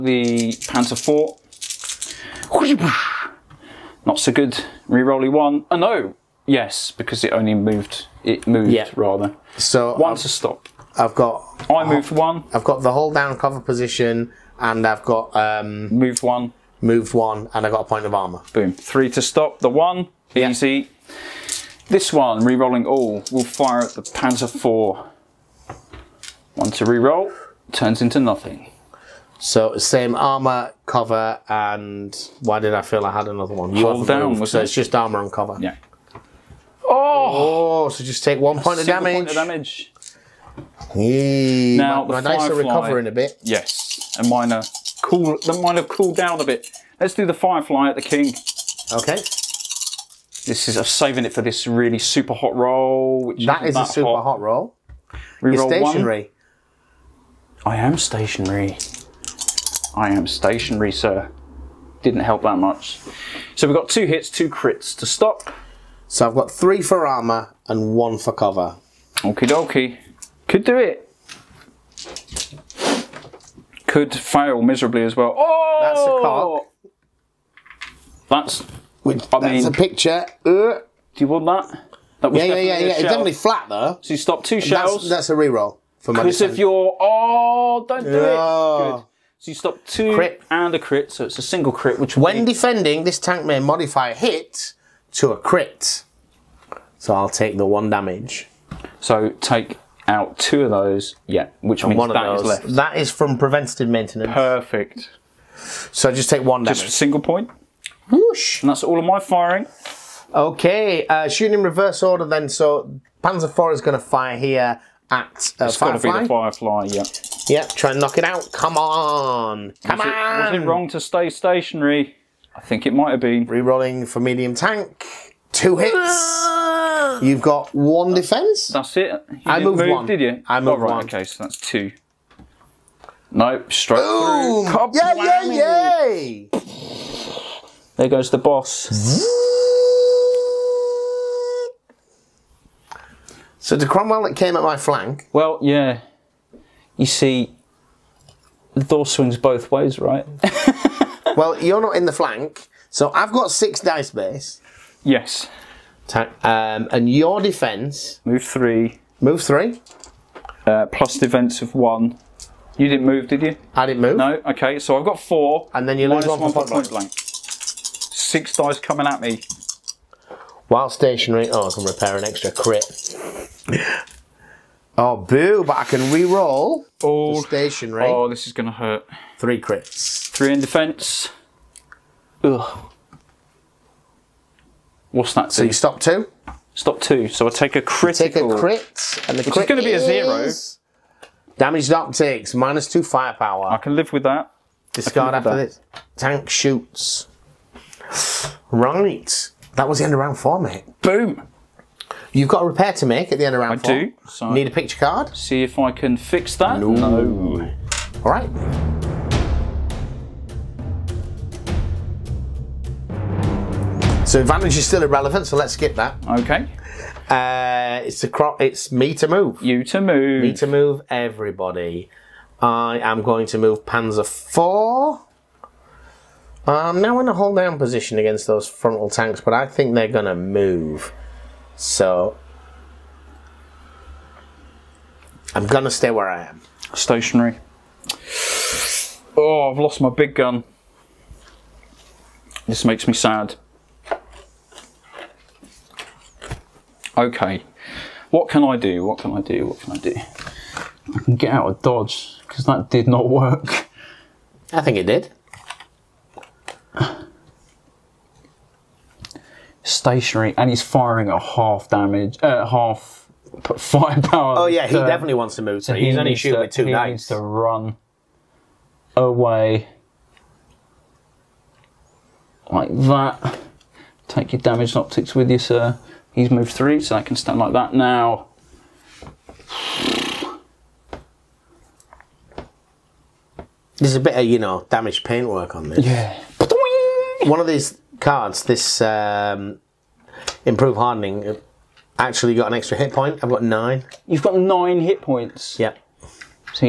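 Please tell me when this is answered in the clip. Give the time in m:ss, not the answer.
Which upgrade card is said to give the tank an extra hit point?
4:50.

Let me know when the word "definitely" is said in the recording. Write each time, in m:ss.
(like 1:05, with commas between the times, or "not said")
1:23, 4:25.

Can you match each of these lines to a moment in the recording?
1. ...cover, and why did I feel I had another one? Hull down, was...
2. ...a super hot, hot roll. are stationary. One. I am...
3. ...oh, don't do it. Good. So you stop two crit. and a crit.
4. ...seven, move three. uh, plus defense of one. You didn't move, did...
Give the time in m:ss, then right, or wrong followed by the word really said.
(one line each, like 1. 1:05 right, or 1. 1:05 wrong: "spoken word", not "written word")
1. 0:30 right
2. 0:53 right
3. 1:26 right
4. 2:38 wrong: "three", not "seven".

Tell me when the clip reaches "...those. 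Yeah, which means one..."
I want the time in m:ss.
1:40.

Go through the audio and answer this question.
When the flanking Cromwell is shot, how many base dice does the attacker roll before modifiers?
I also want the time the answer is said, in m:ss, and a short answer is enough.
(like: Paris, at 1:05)
6, at 2:33.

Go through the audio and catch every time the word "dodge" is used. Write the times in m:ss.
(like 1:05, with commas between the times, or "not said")
4:11.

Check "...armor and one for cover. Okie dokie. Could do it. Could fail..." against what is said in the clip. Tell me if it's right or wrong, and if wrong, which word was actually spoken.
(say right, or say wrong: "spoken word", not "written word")
right.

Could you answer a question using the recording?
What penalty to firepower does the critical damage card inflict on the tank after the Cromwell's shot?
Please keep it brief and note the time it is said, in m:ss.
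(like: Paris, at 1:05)
Minus 2 firepower, at 3:12.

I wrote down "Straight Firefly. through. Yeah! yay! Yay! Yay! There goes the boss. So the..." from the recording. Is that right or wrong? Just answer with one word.
wrong.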